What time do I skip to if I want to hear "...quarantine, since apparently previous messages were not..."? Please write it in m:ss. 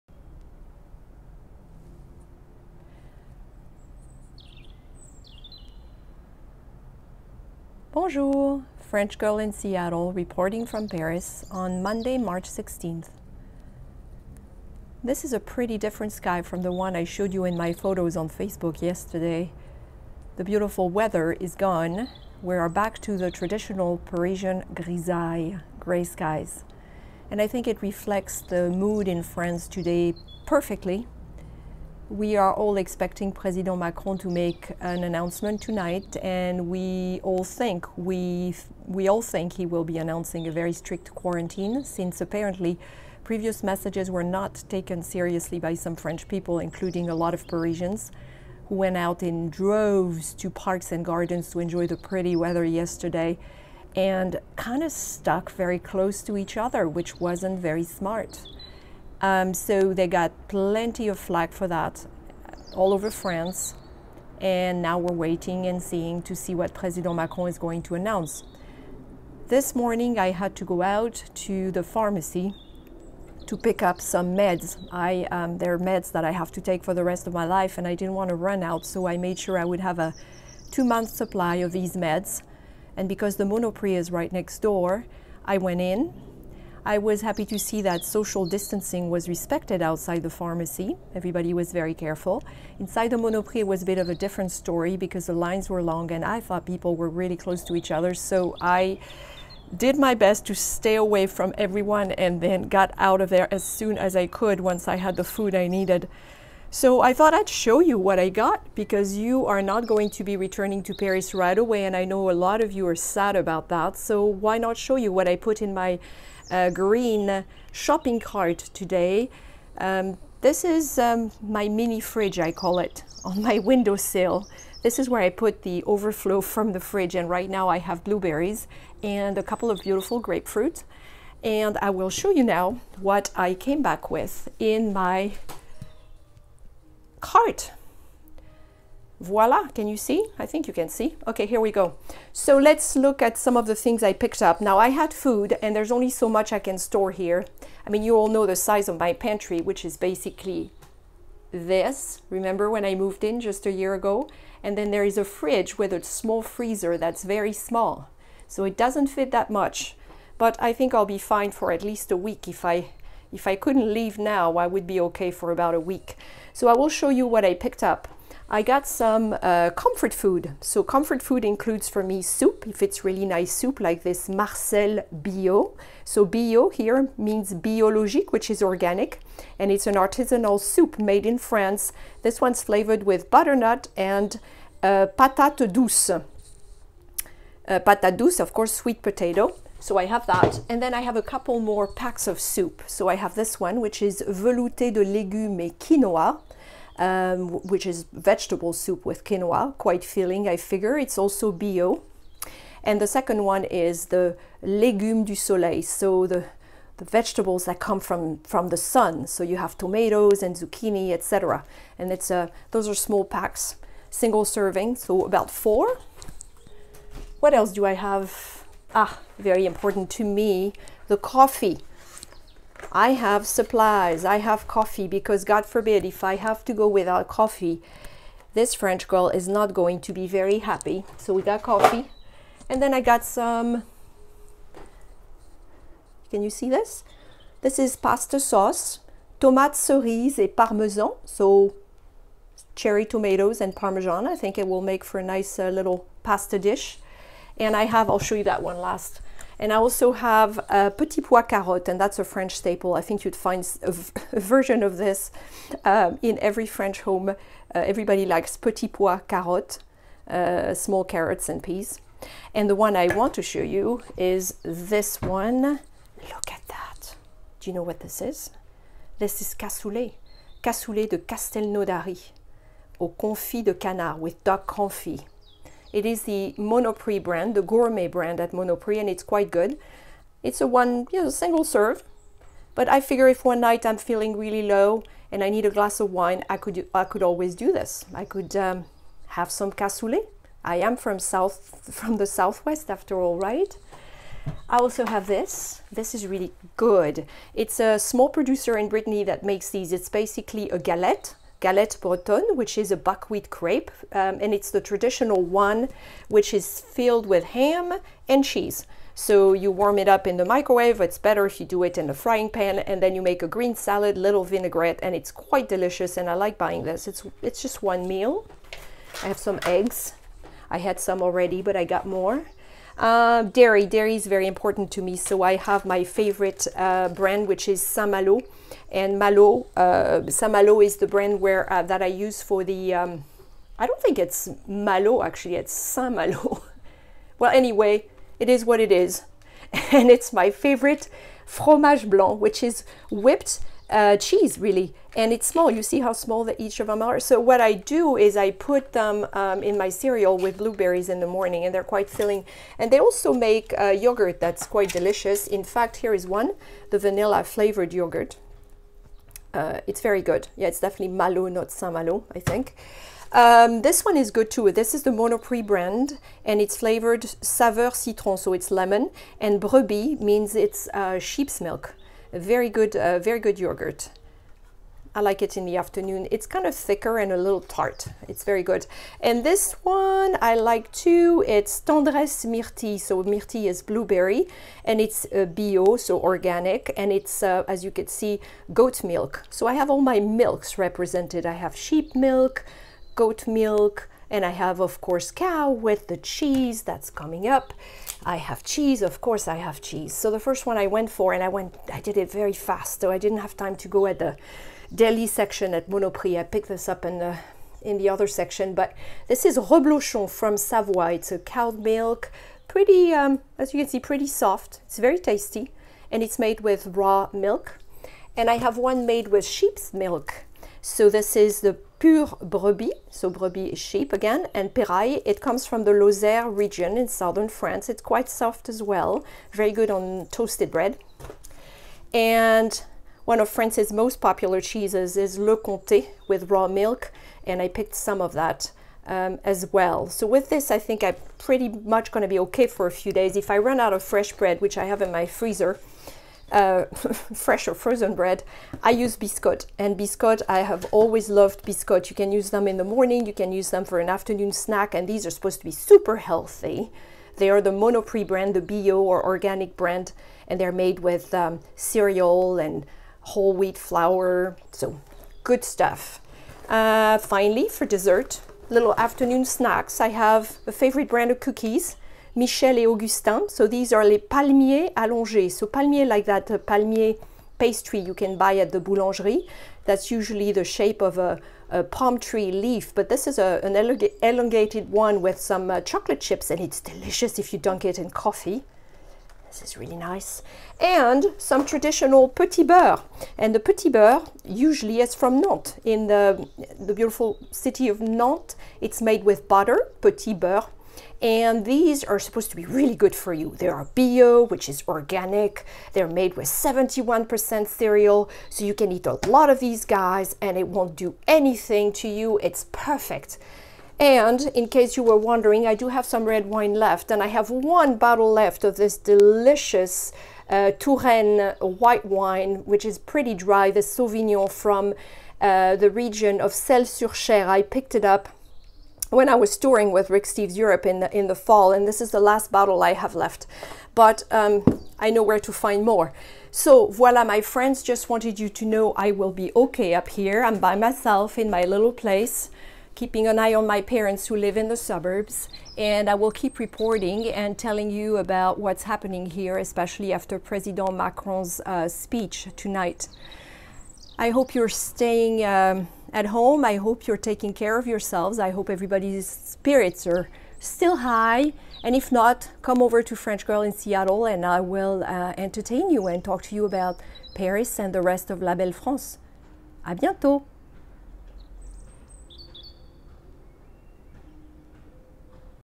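0:41.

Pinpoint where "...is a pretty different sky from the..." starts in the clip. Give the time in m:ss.
0:15.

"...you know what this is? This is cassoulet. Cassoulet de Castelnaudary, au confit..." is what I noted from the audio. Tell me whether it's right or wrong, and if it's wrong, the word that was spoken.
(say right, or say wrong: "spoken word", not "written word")
right.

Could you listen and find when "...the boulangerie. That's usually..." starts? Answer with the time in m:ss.
7:58.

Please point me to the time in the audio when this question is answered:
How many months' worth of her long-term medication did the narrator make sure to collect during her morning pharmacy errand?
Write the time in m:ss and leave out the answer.
1:20.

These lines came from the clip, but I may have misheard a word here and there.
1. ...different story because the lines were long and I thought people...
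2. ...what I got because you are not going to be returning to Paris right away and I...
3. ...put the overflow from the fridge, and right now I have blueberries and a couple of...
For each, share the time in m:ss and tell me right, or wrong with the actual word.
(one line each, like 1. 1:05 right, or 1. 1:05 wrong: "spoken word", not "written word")
1. 1:34 right
2. 1:47 right
3. 2:05 right.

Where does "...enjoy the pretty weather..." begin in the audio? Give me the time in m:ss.
0:51.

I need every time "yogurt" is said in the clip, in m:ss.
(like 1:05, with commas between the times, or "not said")
5:53, 5:57, 6:13.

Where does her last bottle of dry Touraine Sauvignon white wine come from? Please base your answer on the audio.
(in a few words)
Celles-sur-Cher.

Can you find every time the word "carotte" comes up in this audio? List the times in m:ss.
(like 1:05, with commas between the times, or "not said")
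4:11, 4:19.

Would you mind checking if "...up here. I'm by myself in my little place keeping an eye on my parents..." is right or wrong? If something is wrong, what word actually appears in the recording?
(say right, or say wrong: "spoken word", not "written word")
right.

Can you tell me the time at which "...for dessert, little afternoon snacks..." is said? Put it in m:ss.
7:47.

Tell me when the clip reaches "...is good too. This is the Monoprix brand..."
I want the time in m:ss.
6:04.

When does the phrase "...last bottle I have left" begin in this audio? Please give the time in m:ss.
8:52.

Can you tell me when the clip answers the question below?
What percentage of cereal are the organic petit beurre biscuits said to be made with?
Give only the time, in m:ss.
8:26.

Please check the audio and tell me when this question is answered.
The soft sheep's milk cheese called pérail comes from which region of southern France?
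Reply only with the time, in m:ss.
7:05.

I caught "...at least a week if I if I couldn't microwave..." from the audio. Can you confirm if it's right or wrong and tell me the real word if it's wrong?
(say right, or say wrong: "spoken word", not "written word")
wrong: "leave", not "microwave".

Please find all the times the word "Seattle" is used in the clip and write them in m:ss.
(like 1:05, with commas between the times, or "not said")
0:09, 9:23.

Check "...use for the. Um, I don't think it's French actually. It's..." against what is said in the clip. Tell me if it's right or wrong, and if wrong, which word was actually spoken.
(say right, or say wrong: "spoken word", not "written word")
wrong: "Malo", not "French".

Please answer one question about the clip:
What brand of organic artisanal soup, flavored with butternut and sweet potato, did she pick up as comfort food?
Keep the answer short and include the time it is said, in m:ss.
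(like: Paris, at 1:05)
Marcel Bio, at 2:54.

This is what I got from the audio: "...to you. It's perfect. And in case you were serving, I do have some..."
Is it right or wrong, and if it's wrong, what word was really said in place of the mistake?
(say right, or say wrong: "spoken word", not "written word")
wrong: "wondering", not "serving".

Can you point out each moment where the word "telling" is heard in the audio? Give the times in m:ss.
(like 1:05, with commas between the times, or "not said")
9:07.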